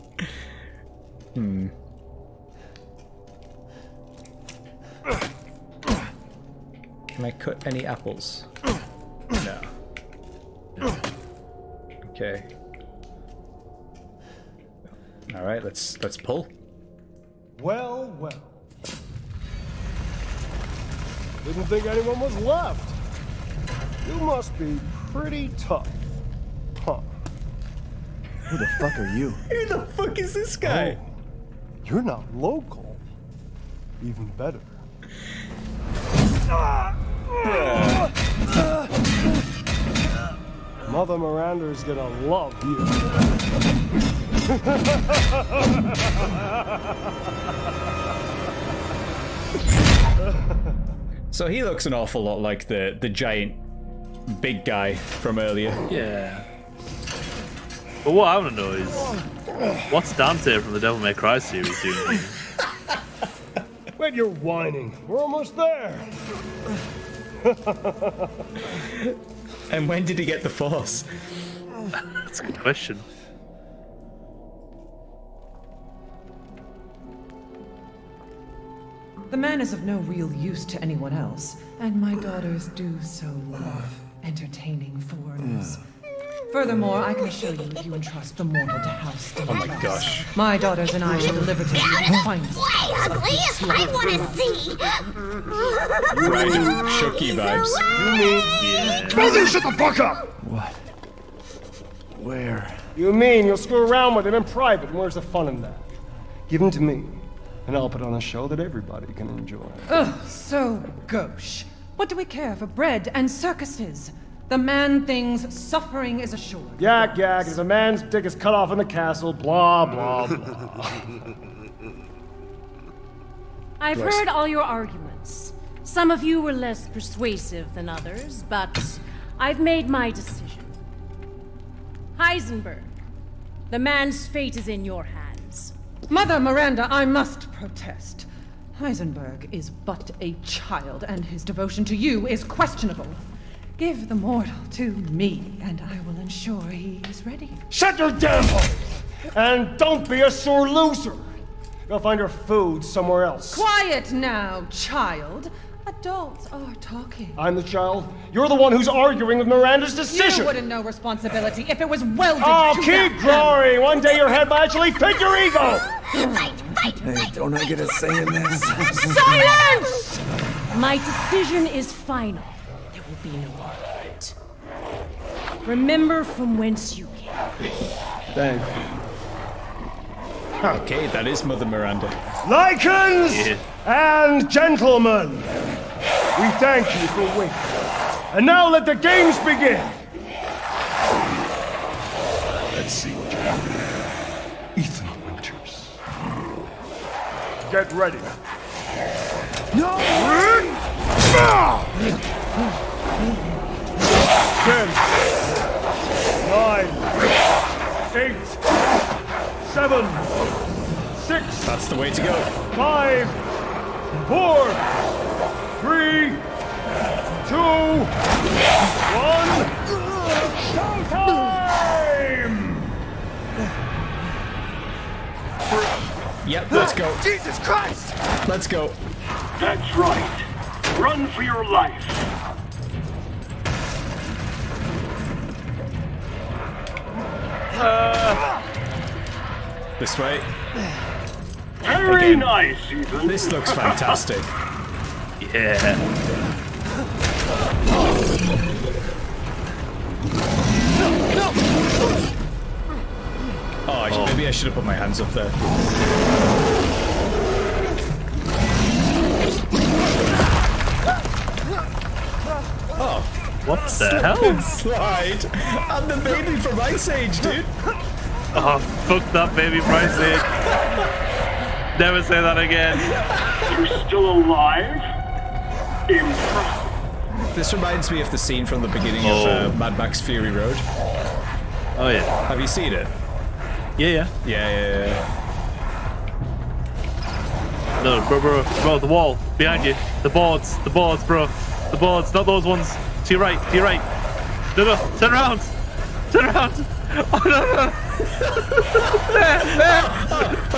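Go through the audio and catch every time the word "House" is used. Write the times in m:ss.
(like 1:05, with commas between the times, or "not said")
1:28.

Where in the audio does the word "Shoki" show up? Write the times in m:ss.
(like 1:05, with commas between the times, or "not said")
1:36.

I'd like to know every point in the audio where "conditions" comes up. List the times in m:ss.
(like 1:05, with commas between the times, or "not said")
not said.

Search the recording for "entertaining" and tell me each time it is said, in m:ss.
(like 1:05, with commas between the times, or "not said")
1:24.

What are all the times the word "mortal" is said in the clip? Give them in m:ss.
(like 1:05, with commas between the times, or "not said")
1:28, 2:24.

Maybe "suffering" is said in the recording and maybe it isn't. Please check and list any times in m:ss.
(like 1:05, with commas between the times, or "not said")
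1:55.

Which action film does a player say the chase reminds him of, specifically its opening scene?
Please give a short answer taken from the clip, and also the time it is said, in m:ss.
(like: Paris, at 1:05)
Mad Max Fury Road, at 4:39.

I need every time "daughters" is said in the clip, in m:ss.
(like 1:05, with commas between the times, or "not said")
1:22, 1:30.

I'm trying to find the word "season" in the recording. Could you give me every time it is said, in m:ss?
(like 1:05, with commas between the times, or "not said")
not said.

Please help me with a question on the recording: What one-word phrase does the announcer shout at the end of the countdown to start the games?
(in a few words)
Showtime.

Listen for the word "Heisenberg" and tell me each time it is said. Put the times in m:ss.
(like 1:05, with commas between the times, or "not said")
2:12, 2:18.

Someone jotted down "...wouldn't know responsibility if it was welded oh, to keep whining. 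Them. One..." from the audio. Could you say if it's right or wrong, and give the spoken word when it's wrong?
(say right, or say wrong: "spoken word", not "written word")
wrong: "growing", not "whining".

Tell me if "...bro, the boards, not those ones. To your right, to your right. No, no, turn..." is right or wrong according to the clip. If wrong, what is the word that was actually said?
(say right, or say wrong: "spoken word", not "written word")
right.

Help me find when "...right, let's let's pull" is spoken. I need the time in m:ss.
0:15.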